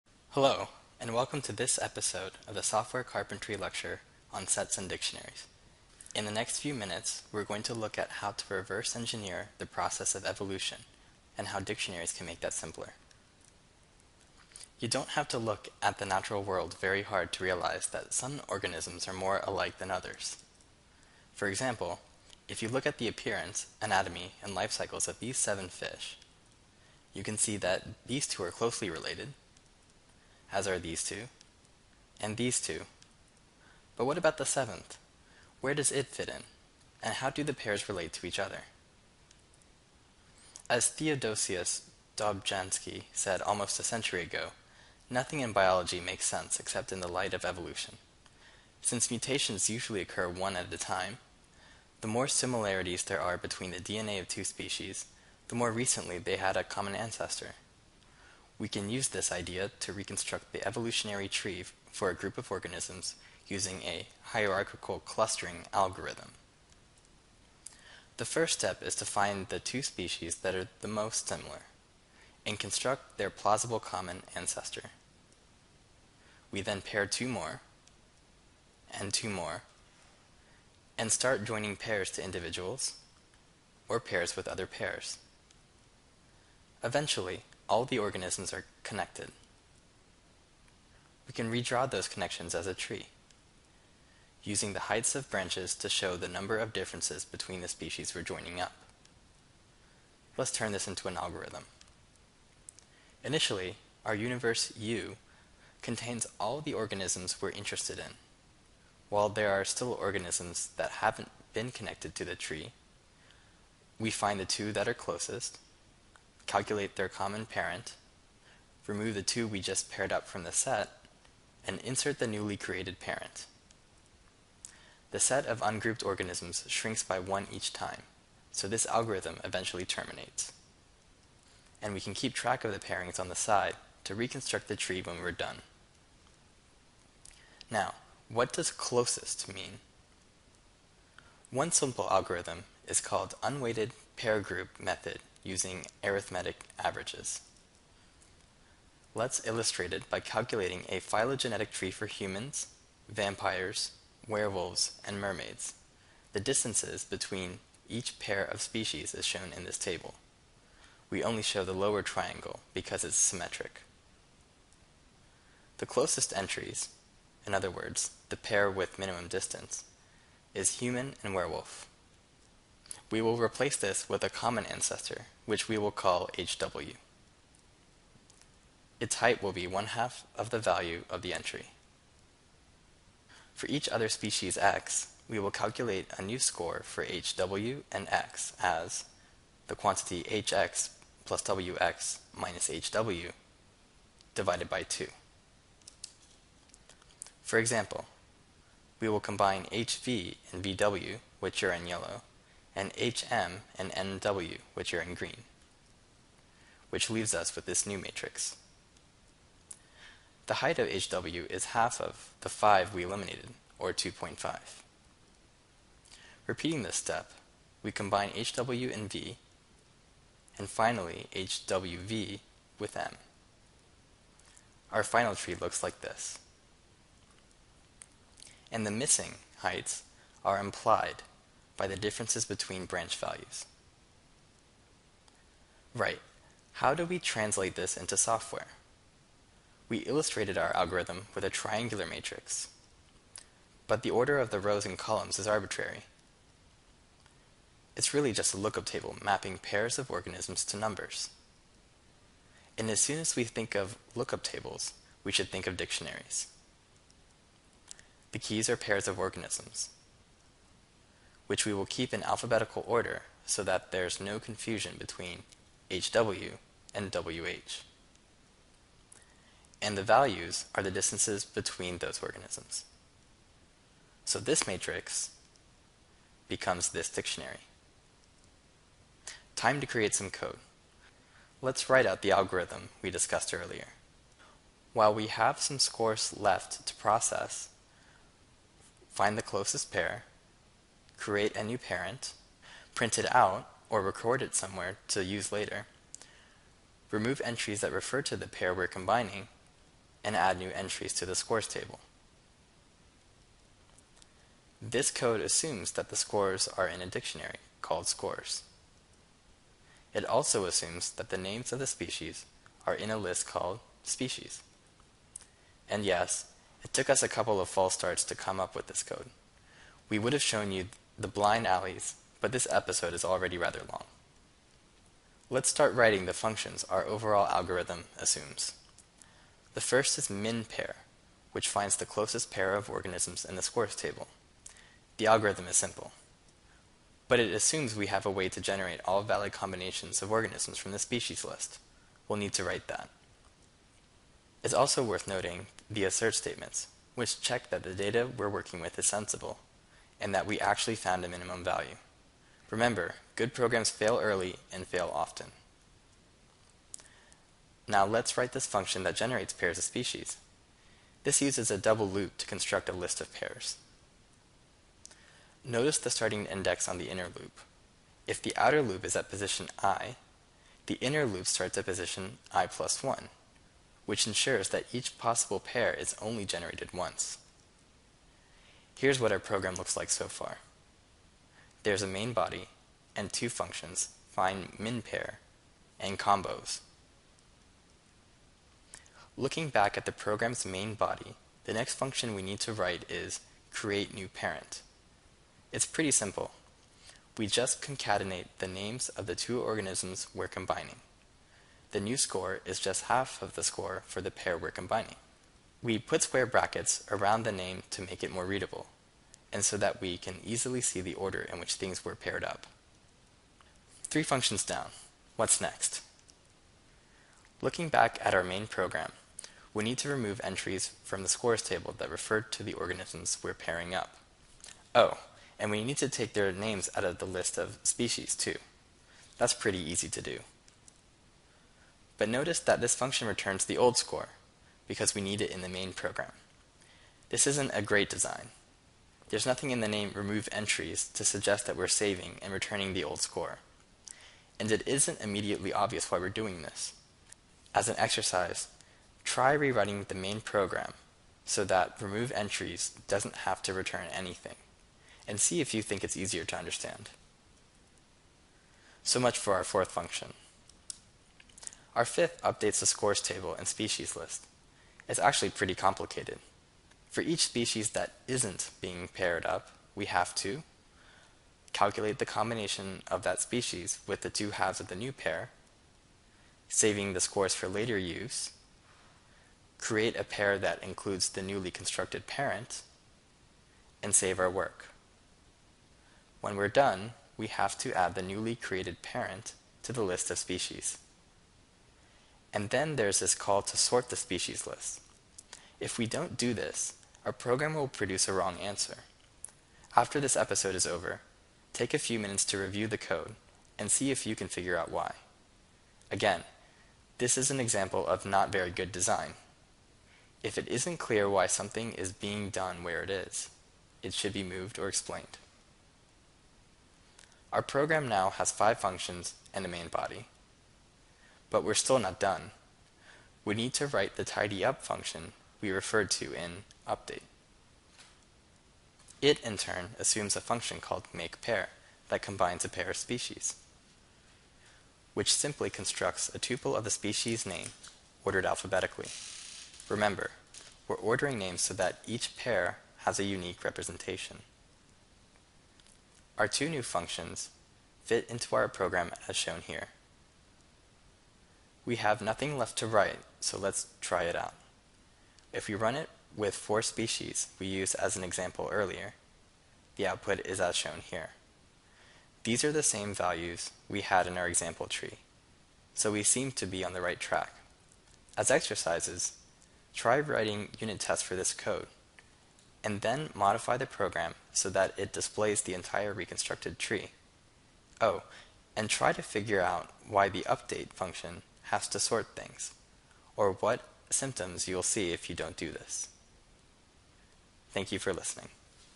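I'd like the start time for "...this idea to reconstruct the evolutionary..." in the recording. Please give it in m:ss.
0:59.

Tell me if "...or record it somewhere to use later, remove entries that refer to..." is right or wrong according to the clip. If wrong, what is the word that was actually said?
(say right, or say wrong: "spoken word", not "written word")
right.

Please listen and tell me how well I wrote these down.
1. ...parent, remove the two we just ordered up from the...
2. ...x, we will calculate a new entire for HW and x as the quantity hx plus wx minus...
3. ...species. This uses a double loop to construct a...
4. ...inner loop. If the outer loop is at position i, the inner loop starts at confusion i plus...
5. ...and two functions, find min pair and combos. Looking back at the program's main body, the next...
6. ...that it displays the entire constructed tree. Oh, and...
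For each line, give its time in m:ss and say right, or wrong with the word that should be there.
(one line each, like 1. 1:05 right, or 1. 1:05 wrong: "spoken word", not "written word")
1. 1:57 wrong: "paired", not "ordered"
2. 3:04 wrong: "score", not "entire"
3. 5:59 right
4. 6:07 wrong: "position", not "confusion"
5. 6:23 right
6. 9:34 wrong: "reconstructed", not "constructed".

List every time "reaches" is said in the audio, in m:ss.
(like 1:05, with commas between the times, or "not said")
not said.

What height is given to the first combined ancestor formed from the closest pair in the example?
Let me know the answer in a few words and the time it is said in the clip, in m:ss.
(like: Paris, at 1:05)
2.5, at 3:33.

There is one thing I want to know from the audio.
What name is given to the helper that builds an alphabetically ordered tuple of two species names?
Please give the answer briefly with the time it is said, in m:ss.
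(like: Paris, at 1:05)
makePair, at 8:51.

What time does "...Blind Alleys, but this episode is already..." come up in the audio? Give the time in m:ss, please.
5:21.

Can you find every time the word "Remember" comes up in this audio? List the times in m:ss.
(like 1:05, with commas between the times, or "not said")
5:52, 8:59.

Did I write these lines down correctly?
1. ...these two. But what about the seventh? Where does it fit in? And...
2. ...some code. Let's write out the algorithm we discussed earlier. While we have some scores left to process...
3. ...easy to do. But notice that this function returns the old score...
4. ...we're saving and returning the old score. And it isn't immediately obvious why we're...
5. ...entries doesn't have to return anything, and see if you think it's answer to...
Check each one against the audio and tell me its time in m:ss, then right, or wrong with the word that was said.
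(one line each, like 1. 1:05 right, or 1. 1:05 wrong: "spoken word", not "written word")
1. 0:32 right
2. 4:40 right
3. 7:09 right
4. 7:21 right
5. 7:32 wrong: "easier", not "answer".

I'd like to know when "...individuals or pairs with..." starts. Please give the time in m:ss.
1:22.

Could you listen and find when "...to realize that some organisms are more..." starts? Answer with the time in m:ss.
0:17.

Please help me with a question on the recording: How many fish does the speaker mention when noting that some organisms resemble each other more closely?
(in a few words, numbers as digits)
7.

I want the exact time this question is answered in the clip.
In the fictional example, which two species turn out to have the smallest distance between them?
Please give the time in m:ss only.
2:50.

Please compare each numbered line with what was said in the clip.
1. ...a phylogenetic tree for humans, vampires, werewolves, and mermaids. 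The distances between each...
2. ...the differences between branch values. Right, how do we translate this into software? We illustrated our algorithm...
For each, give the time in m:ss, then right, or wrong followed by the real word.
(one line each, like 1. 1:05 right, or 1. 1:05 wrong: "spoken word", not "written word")
1. 2:30 right
2. 3:51 right.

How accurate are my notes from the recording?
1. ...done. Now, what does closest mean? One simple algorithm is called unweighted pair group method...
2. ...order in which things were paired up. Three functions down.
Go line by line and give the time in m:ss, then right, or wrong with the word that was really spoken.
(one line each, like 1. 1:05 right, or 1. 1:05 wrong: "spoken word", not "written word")
1. 2:15 right
2. 6:51 right.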